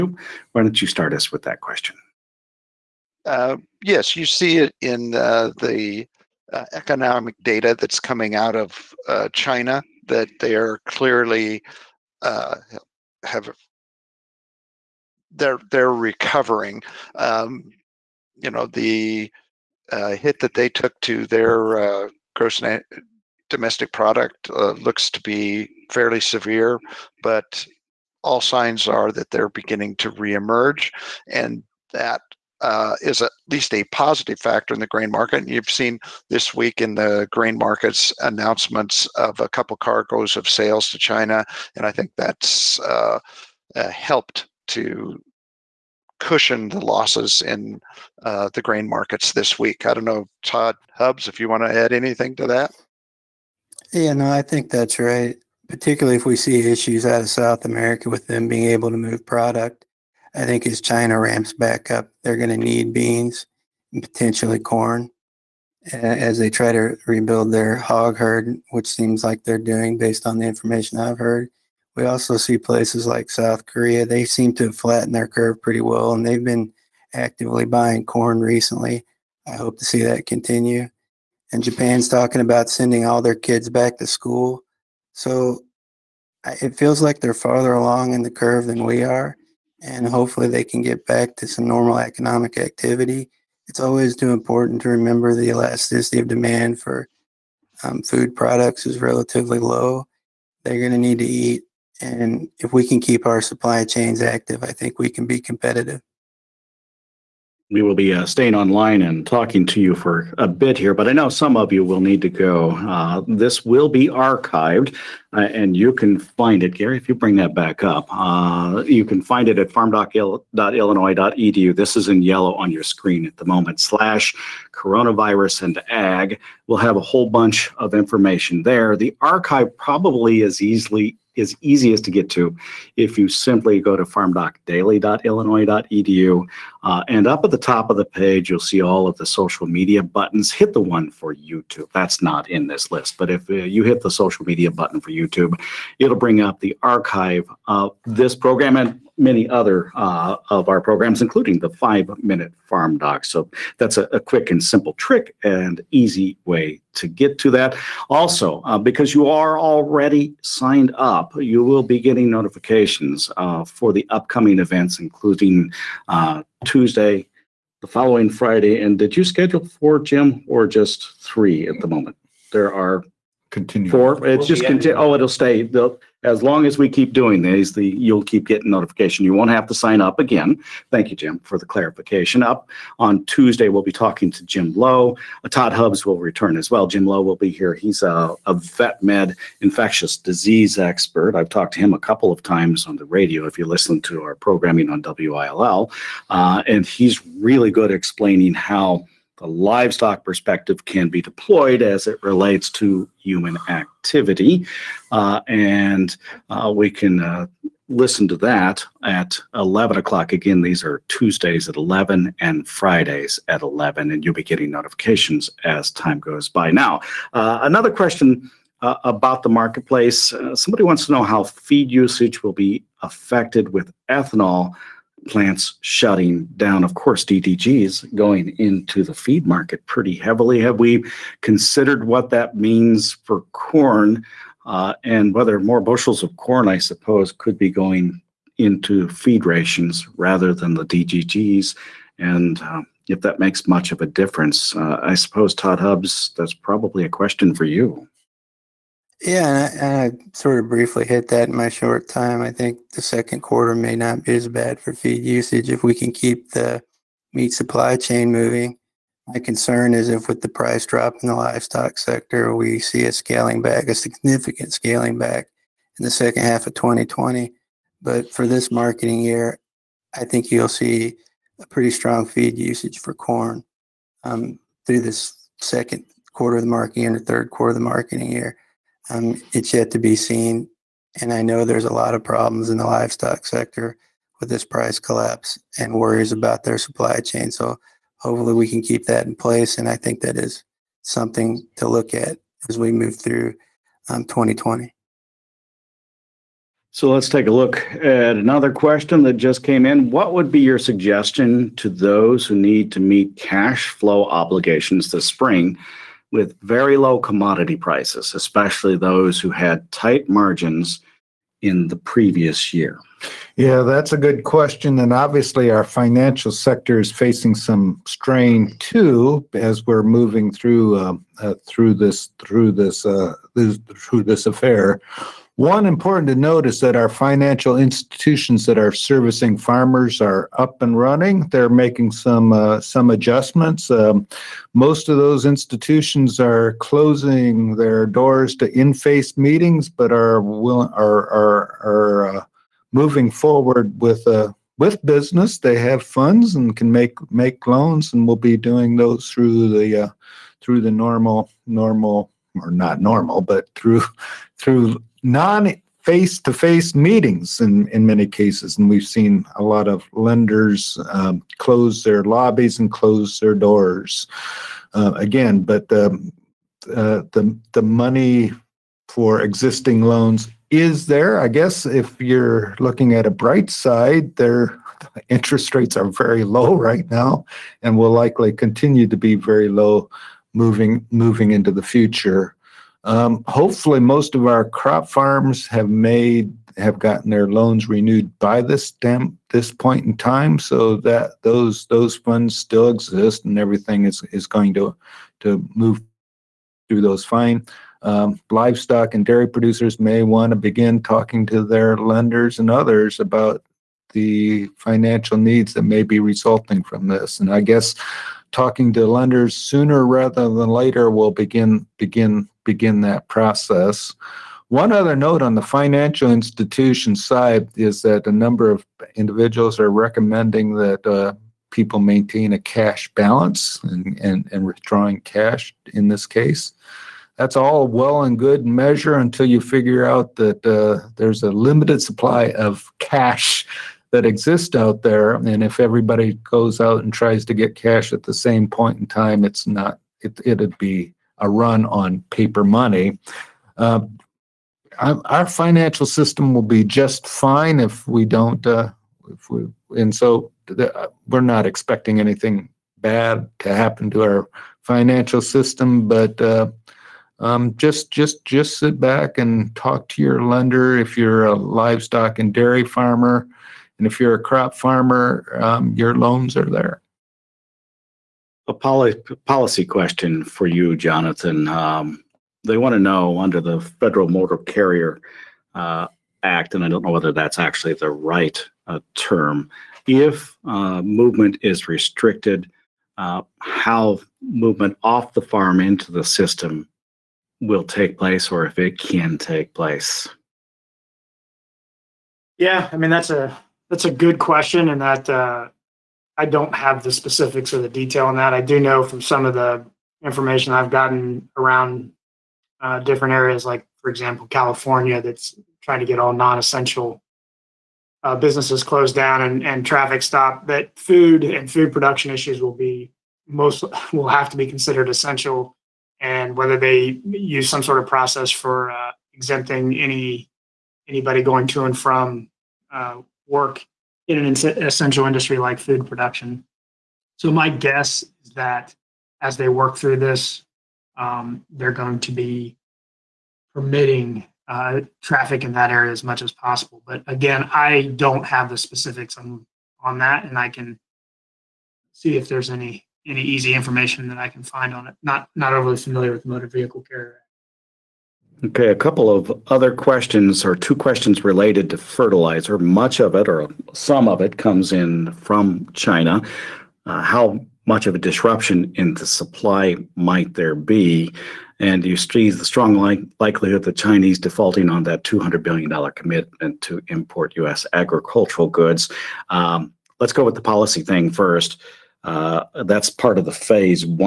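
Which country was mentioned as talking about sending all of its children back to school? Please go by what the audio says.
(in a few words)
Japan.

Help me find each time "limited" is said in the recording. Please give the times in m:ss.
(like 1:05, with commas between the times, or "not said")
7:11.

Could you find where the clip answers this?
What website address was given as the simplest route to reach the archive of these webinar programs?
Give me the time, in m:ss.
2:14.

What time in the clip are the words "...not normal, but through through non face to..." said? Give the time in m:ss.
5:52.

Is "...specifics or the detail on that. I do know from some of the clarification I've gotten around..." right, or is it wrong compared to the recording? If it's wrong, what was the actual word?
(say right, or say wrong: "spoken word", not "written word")
wrong: "information", not "clarification".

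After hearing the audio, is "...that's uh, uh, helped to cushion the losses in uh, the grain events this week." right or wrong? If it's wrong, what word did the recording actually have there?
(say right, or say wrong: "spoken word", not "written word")
wrong: "markets", not "events".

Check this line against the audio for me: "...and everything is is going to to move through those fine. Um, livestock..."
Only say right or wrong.
right.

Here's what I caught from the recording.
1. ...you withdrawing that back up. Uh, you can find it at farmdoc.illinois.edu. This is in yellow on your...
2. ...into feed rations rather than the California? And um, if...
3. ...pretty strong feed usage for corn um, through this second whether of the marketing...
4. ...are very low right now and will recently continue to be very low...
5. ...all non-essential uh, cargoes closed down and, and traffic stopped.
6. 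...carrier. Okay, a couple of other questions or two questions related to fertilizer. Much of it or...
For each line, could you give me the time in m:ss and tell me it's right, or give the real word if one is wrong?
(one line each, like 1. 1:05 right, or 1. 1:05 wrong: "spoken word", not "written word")
1. 1:57 wrong: "bring", not "withdrawing"
2. 3:58 wrong: "DDGs", not "California"
3. 4:31 wrong: "quarter", not "whether"
4. 6:15 wrong: "likely", not "recently"
5. 8:26 wrong: "businesses", not "cargoes"
6. 9:07 right.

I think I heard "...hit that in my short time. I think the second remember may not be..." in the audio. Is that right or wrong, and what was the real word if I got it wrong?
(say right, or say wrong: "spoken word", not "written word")
wrong: "quarter", not "remember".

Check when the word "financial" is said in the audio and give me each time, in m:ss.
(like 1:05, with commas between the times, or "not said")
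5:15, 5:27, 6:44, 6:55, 7:25, 7:34.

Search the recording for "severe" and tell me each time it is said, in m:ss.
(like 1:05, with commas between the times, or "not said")
0:26.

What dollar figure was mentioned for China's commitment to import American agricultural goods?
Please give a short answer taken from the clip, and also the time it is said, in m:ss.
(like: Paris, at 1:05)
$200 billion, at 9:25.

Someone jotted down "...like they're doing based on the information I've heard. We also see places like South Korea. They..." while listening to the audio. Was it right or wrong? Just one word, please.
right.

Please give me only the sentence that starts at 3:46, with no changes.
Of course, DDG is going into the feed market pretty heavily.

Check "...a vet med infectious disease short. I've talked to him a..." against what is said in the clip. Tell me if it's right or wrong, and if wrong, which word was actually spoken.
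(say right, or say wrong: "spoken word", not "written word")
wrong: "expert", not "short".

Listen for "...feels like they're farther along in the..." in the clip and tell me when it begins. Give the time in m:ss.
1:26.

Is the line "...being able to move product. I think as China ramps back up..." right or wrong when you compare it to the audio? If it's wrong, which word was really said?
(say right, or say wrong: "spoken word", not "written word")
right.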